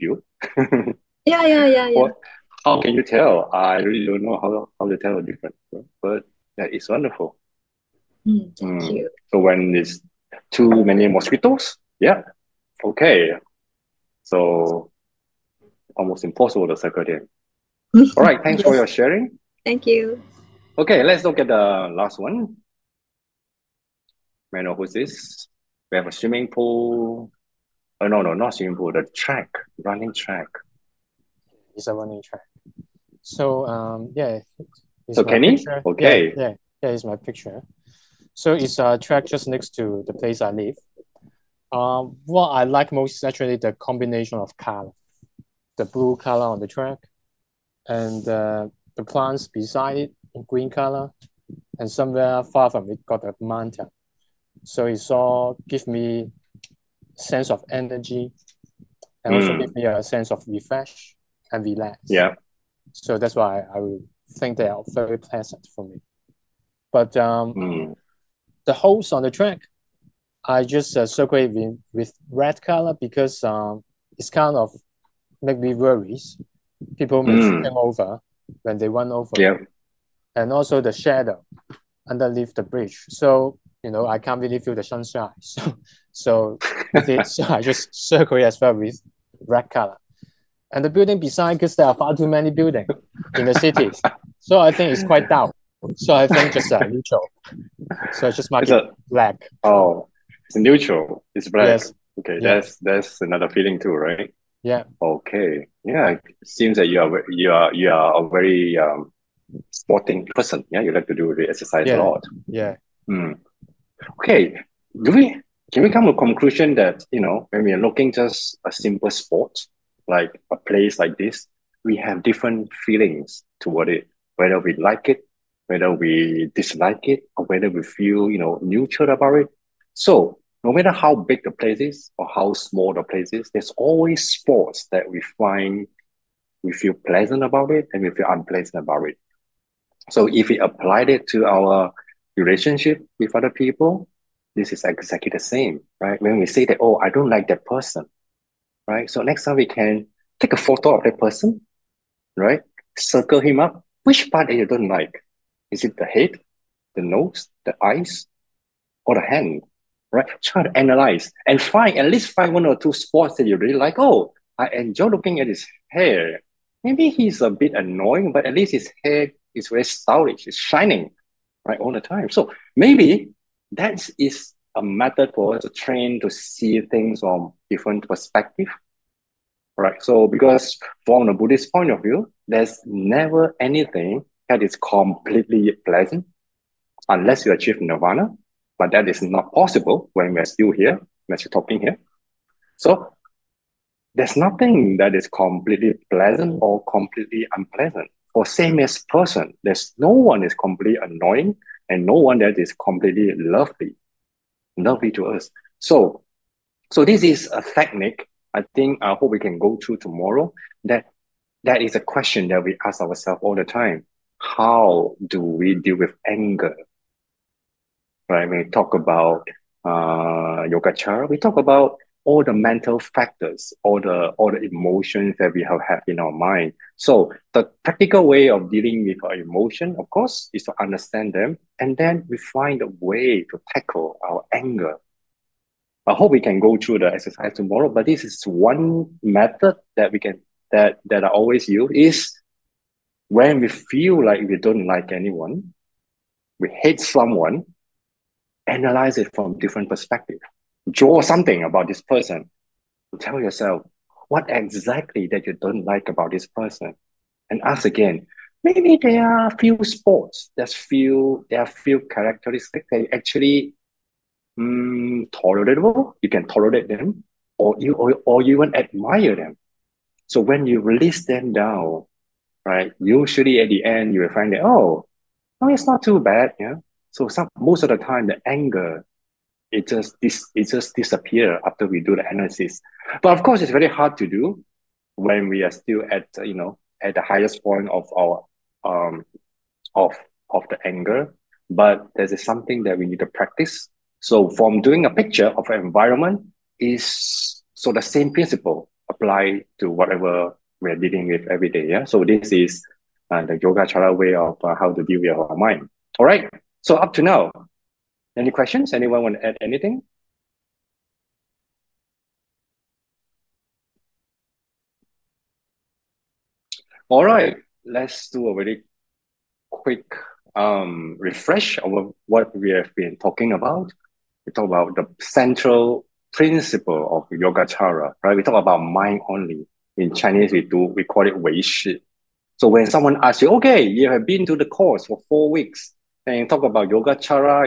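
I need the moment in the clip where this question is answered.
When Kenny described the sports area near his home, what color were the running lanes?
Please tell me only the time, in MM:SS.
00:45.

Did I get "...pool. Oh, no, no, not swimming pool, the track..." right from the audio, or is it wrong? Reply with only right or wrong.
right.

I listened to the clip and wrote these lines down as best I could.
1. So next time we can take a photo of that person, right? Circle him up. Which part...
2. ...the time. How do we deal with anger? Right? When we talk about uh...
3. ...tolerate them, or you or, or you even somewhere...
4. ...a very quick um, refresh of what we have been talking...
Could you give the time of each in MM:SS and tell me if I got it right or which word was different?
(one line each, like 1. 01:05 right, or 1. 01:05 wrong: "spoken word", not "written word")
1. 02:29 right
2. 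03:33 right
3. 04:26 wrong: "admire", not "somewhere"
4. 05:18 right.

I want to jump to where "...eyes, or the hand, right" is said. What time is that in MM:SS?
02:37.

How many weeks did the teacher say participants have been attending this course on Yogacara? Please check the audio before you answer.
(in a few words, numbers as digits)
4.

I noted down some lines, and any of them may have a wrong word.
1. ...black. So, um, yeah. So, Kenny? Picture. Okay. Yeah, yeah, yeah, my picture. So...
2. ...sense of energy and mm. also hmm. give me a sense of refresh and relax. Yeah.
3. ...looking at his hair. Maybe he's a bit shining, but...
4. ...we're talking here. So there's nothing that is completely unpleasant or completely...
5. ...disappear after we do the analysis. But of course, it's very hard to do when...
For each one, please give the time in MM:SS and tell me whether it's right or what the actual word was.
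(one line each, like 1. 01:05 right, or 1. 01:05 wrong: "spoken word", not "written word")
1. 00:32 wrong: "track", not "black"
2. 00:57 right
3. 02:45 wrong: "annoying", not "shining"
4. 03:11 wrong: "pleasant", not "unpleasant"
5. 04:40 right.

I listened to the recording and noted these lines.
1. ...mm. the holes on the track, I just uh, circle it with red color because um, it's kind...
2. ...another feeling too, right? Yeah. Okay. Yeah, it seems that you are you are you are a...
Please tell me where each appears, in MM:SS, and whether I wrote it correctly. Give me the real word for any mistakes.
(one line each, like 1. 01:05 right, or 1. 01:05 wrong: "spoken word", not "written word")
1. 01:07 right
2. 01:43 right.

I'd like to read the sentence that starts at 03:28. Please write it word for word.
I think I hope we can go through tomorrow.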